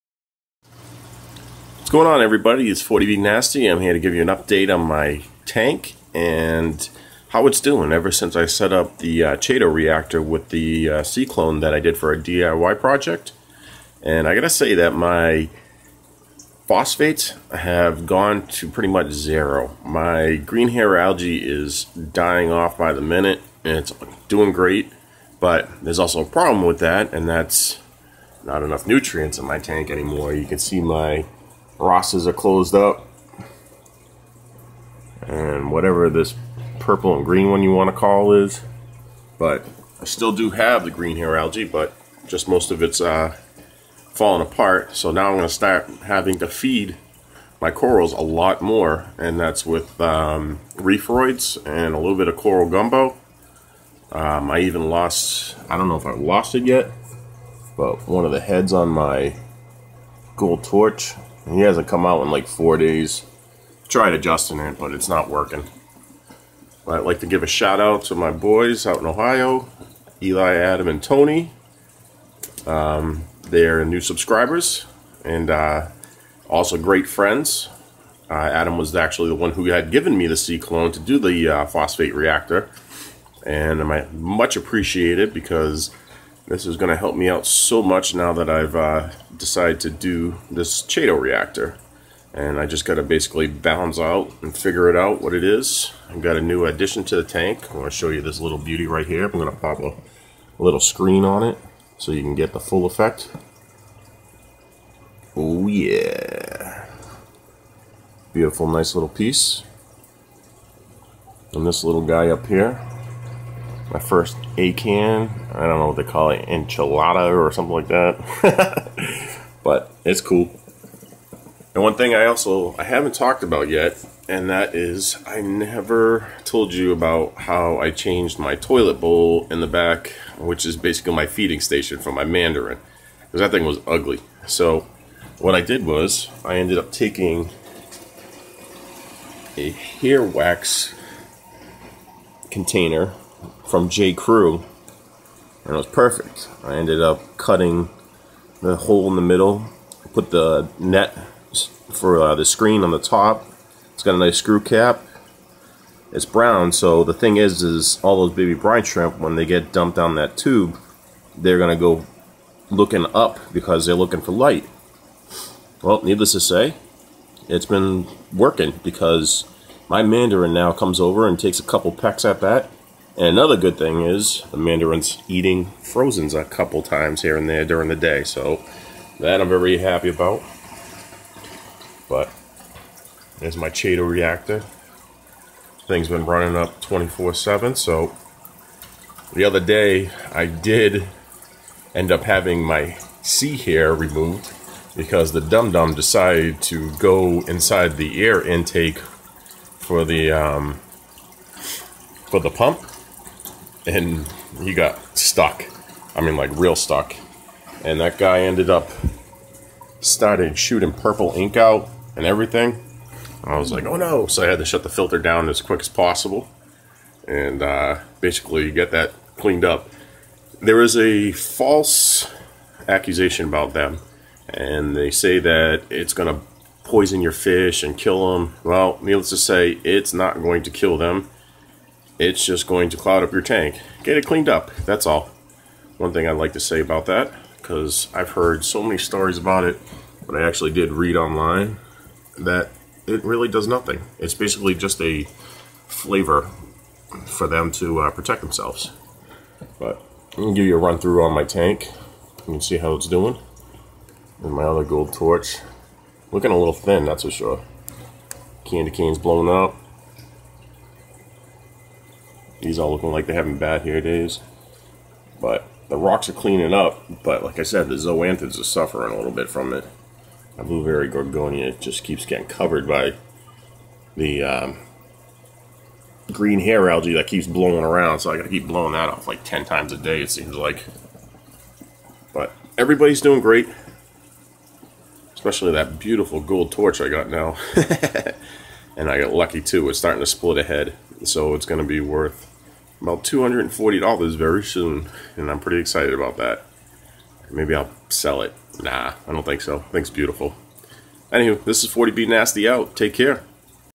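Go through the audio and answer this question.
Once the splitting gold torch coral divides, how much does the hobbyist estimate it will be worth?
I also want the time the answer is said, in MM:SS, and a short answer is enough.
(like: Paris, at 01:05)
$240, at 04:53.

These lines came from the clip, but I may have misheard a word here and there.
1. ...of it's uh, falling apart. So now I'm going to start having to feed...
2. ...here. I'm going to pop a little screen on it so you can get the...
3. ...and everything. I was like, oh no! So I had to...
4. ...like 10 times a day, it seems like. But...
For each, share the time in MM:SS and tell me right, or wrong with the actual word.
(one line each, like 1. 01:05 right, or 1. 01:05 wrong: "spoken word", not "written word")
1. 00:42 right
2. 01:39 right
3. 03:32 right
4. 04:39 right.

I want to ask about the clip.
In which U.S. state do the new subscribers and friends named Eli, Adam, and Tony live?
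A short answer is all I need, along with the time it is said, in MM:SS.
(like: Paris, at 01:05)
Ohio, at 01:09.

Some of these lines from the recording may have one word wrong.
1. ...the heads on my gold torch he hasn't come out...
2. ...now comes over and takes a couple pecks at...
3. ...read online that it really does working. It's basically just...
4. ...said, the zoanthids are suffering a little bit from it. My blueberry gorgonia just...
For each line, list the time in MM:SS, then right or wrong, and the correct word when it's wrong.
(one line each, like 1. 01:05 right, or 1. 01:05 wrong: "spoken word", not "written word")
1. 00:58 right
2. 02:50 right
3. 04:00 wrong: "nothing", not "working"
4. 04:27 right.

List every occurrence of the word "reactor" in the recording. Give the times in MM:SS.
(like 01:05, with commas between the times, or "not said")
00:09, 01:22, 01:31, 03:04.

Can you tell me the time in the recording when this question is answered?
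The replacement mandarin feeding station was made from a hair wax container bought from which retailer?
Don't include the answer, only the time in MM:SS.
02:23.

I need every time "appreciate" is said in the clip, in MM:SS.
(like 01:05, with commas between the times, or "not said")
01:24.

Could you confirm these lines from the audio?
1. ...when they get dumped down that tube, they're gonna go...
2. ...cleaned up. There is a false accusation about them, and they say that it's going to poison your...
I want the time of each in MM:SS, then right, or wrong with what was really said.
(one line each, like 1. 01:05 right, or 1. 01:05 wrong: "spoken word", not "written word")
1. 02:39 right
2. 03:39 right.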